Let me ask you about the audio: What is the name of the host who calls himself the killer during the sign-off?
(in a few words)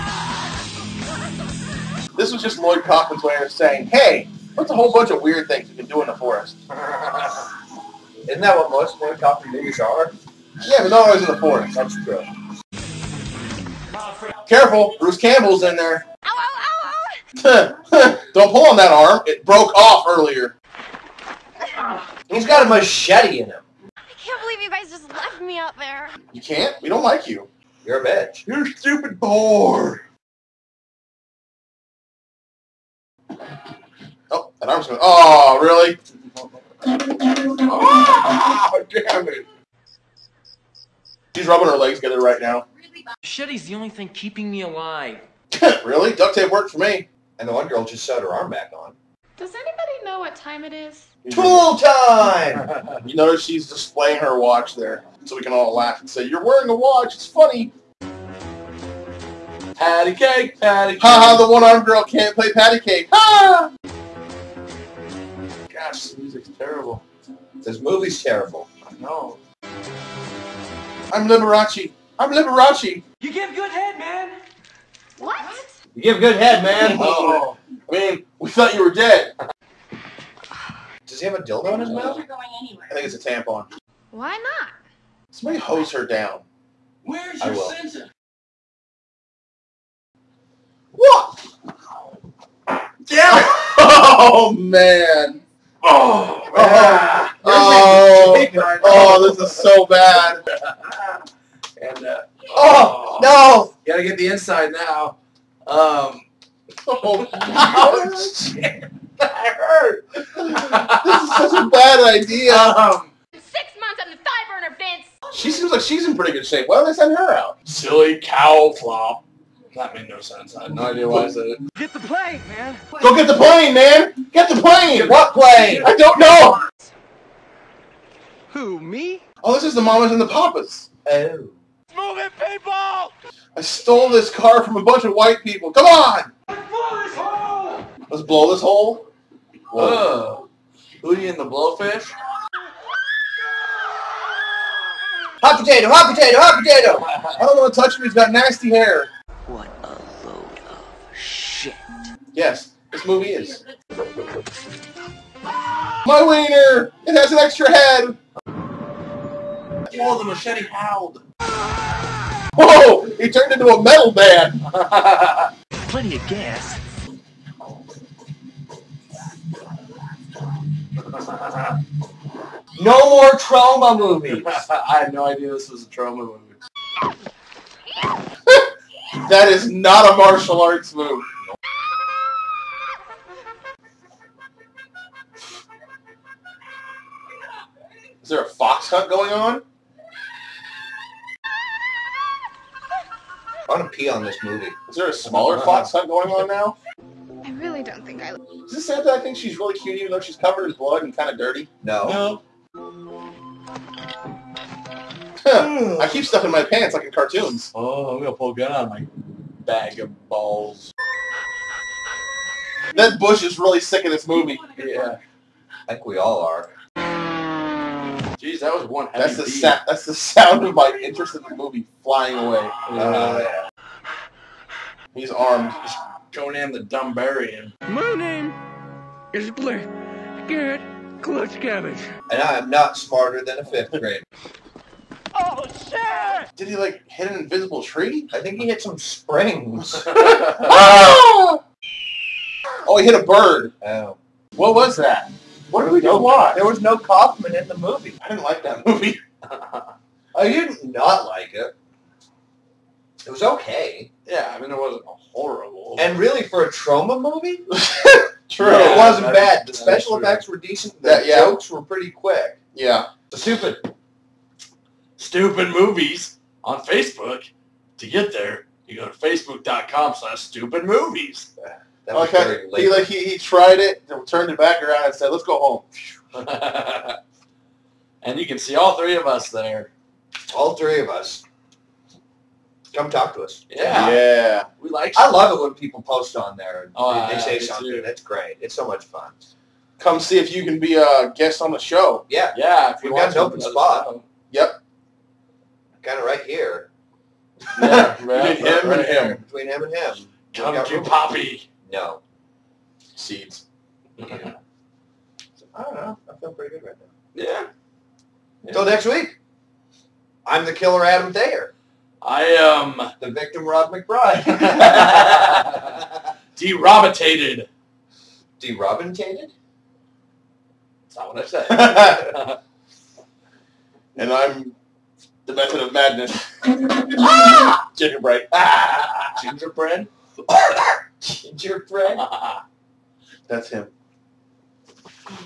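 Adam Thayer.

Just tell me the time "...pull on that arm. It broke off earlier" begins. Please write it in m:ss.
0:18.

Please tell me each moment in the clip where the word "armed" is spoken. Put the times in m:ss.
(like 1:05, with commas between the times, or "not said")
1:01, 3:45.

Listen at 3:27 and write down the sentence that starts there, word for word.
Oh, I'm gonna pull a gun out of my bag of balls.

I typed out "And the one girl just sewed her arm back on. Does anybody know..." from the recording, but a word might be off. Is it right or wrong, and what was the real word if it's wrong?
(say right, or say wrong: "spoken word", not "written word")
right.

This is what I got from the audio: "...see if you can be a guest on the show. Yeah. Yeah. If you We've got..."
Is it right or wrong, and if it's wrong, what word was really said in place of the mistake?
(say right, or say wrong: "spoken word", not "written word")
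right.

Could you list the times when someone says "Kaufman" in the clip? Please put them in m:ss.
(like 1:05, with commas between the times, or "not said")
0:02, 0:09, 4:06.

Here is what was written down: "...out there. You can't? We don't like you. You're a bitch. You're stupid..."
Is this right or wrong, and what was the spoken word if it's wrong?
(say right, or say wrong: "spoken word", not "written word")
right.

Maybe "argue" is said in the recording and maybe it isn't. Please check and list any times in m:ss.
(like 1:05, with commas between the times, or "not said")
not said.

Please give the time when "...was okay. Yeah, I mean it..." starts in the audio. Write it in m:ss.
4:13.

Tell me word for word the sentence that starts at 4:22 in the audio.
Yeah, the stupid, stupid movies on Facebook.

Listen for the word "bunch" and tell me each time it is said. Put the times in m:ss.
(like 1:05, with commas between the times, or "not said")
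0:04, 2:14.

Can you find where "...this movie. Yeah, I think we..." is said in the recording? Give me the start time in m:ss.
3:34.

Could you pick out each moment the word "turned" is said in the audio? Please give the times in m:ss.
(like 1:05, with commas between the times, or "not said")
2:43, 4:34.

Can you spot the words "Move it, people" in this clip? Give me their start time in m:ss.
2:11.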